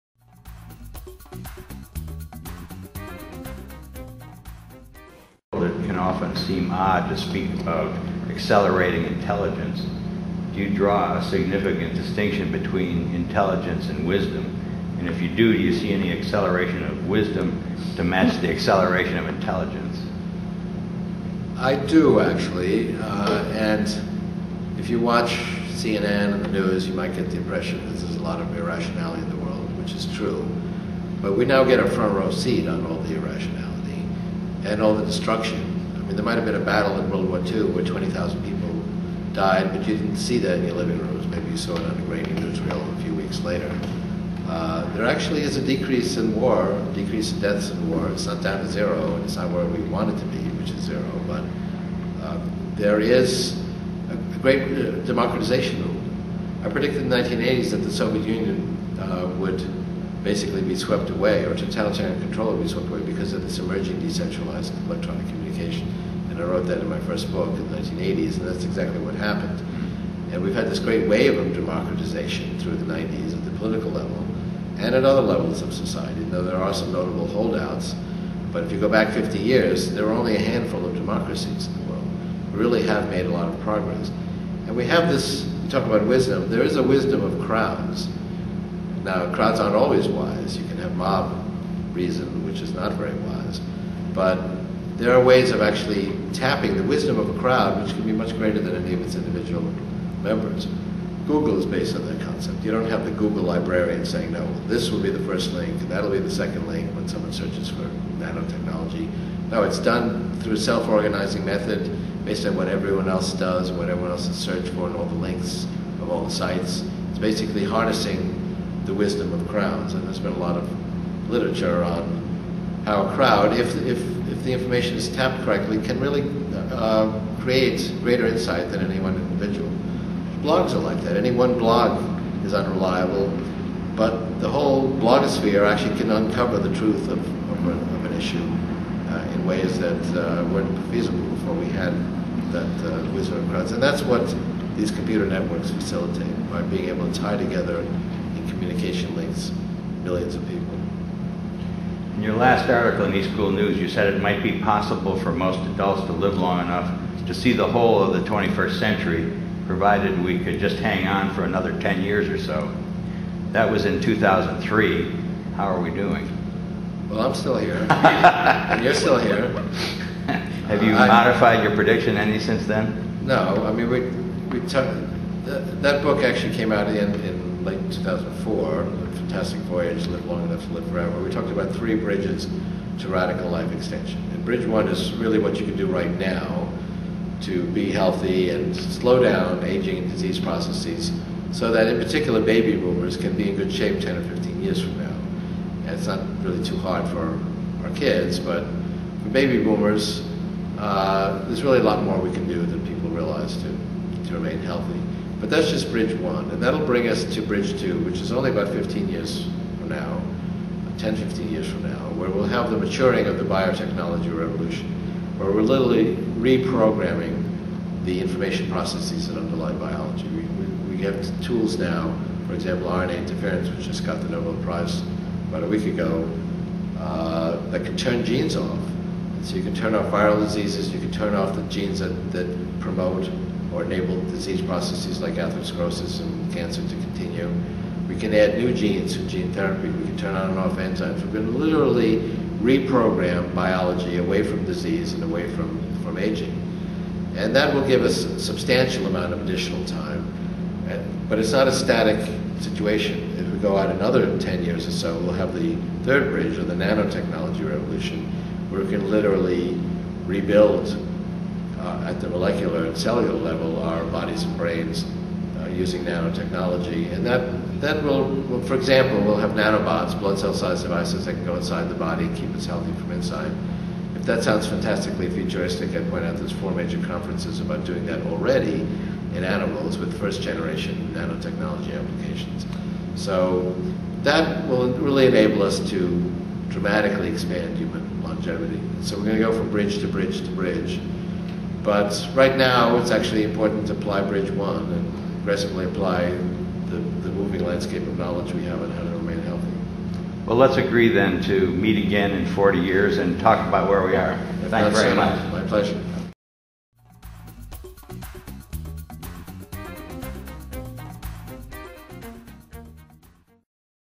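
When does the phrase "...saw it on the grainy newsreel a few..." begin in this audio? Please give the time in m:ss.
0:41.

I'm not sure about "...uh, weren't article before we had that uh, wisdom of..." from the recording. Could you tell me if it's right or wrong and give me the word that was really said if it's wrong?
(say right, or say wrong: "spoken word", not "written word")
wrong: "feasible", not "article".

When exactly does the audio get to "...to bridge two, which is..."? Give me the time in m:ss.
3:27.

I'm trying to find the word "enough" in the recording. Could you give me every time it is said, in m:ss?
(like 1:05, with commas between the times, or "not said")
2:36, 3:00.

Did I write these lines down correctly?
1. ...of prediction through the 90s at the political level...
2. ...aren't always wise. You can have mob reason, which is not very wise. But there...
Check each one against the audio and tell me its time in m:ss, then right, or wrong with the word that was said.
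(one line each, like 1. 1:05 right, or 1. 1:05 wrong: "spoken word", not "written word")
1. 1:11 wrong: "democratization", not "prediction"
2. 1:29 right.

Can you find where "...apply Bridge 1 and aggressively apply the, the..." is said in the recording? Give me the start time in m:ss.
4:53.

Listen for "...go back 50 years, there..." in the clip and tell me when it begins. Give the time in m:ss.
1:18.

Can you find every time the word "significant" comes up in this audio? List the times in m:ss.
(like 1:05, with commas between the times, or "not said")
0:11.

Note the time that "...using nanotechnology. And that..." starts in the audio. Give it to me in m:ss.
4:25.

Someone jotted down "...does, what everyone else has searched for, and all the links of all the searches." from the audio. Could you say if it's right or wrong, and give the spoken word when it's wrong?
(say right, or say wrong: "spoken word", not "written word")
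wrong: "sites", not "searches".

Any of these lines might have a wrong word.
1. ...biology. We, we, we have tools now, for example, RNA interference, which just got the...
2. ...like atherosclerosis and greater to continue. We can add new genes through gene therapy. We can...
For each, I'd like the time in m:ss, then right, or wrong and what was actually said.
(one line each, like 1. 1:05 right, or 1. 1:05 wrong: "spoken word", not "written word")
1. 3:39 right
2. 3:55 wrong: "cancer", not "greater".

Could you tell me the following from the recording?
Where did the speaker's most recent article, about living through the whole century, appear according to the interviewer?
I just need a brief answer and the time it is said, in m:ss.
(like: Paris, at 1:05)
eSchool News, at 2:33.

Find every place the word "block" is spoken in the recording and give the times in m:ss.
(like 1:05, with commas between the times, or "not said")
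not said.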